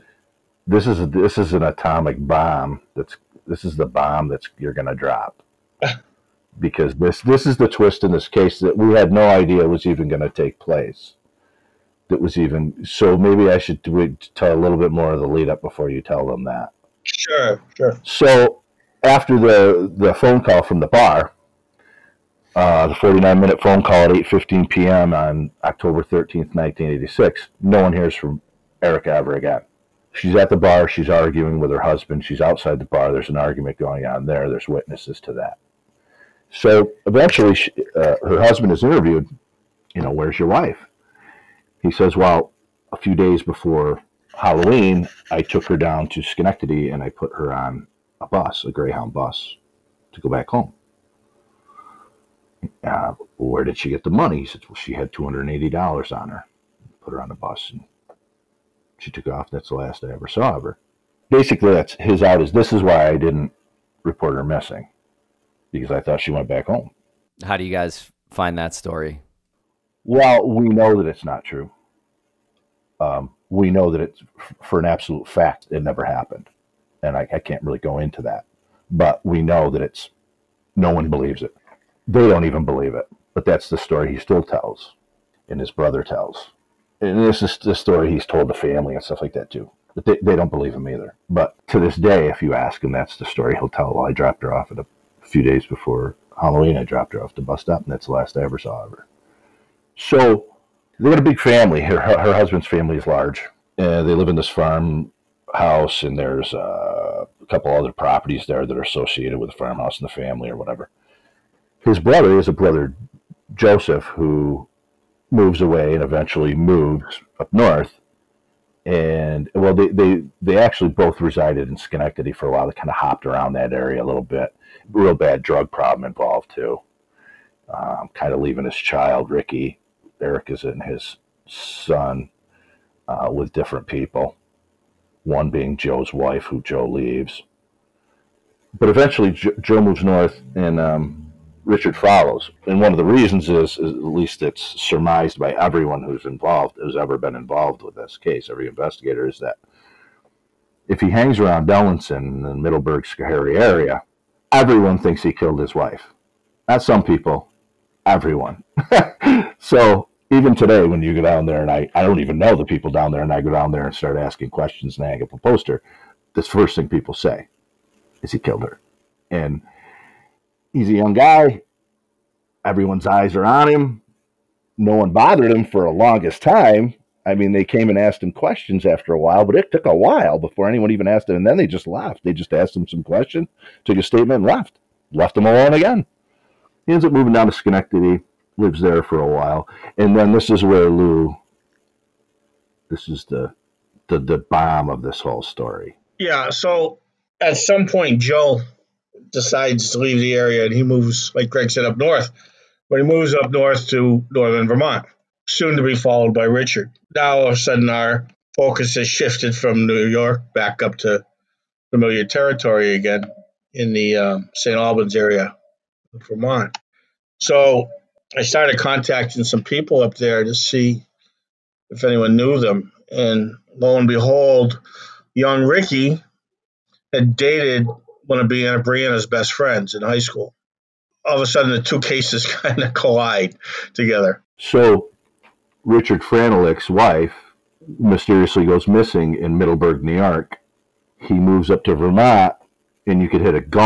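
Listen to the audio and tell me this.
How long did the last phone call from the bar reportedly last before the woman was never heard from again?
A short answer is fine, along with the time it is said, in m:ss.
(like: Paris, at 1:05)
49 minutes, at 0:22.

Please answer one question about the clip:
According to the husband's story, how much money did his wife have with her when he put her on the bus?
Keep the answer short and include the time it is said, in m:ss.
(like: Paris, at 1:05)
$280, at 0:55.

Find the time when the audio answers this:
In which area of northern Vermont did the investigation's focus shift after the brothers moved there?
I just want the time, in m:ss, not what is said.
3:34.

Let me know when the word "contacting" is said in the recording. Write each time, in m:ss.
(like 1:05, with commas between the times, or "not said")
3:38.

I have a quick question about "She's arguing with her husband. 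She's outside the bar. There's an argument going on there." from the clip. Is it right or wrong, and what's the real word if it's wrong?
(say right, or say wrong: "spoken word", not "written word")
right.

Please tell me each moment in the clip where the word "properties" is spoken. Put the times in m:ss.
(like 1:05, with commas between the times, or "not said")
1:47.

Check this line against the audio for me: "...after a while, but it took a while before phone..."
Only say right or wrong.
wrong.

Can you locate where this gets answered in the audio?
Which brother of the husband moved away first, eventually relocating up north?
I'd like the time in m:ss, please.
1:53.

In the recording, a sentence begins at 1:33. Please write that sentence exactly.
Well, I dropped her off at a few days before Halloween.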